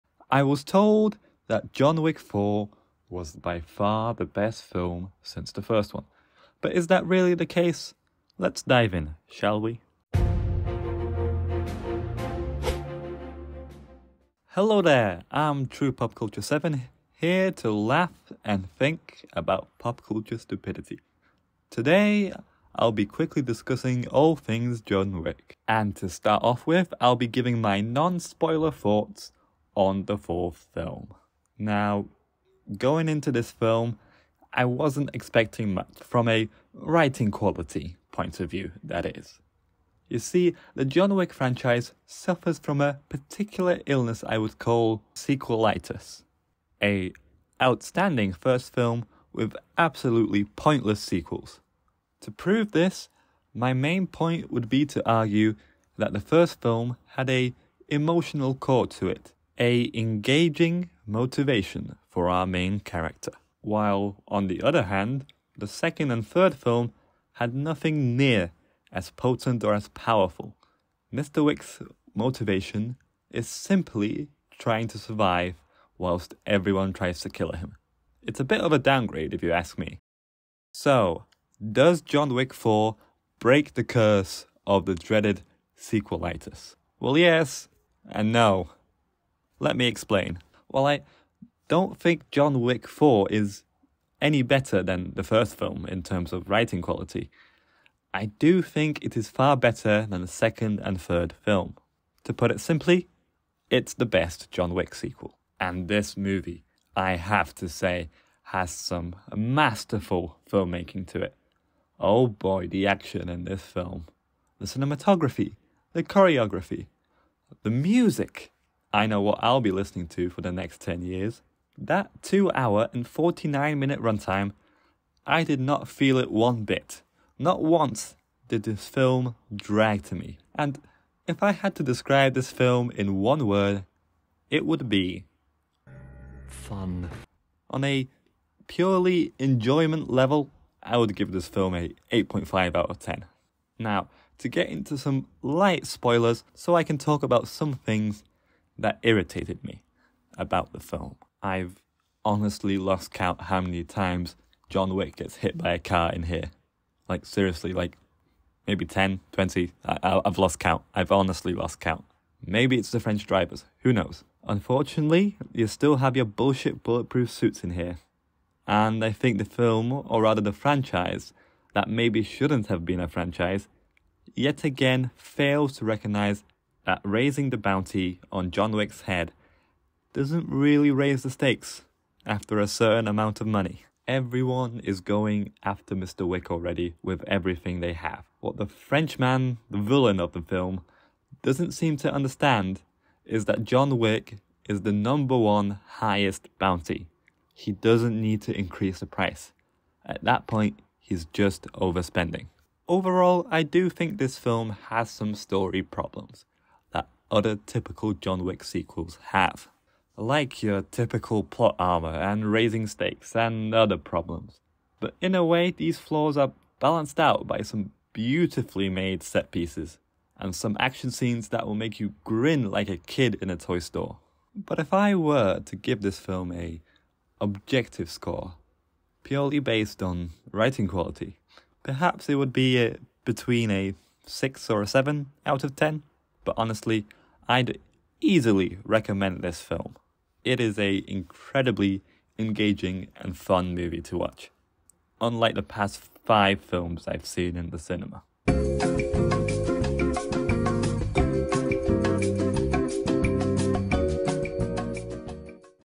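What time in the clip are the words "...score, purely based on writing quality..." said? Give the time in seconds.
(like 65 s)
228 s.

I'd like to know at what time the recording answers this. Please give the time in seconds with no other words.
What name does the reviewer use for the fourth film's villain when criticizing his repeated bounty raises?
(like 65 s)
188 s.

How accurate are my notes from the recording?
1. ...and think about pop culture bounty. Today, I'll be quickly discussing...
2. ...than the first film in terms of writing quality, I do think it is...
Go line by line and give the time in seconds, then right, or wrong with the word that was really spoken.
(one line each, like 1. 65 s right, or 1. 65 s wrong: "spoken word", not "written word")
1. 18 s wrong: "stupidity", not "bounty"
2. 94 s right.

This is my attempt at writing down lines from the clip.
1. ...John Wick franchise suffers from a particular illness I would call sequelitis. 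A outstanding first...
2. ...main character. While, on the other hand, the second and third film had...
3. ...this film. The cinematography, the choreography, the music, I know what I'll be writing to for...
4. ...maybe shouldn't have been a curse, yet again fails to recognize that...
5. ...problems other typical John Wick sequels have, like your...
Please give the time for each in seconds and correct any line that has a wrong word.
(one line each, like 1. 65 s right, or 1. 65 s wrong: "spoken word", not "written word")
1. 40 s right
2. 62 s right
3. 113 s wrong: "listening", not "writing"
4. 171 s wrong: "franchise", not "curse"
5. 205 s right.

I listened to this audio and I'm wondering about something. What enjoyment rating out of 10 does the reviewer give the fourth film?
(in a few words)
8.5.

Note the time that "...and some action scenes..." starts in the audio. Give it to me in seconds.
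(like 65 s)
220 s.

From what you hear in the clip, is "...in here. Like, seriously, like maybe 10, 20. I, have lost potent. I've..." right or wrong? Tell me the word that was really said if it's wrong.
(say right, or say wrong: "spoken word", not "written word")
wrong: "count", not "potent".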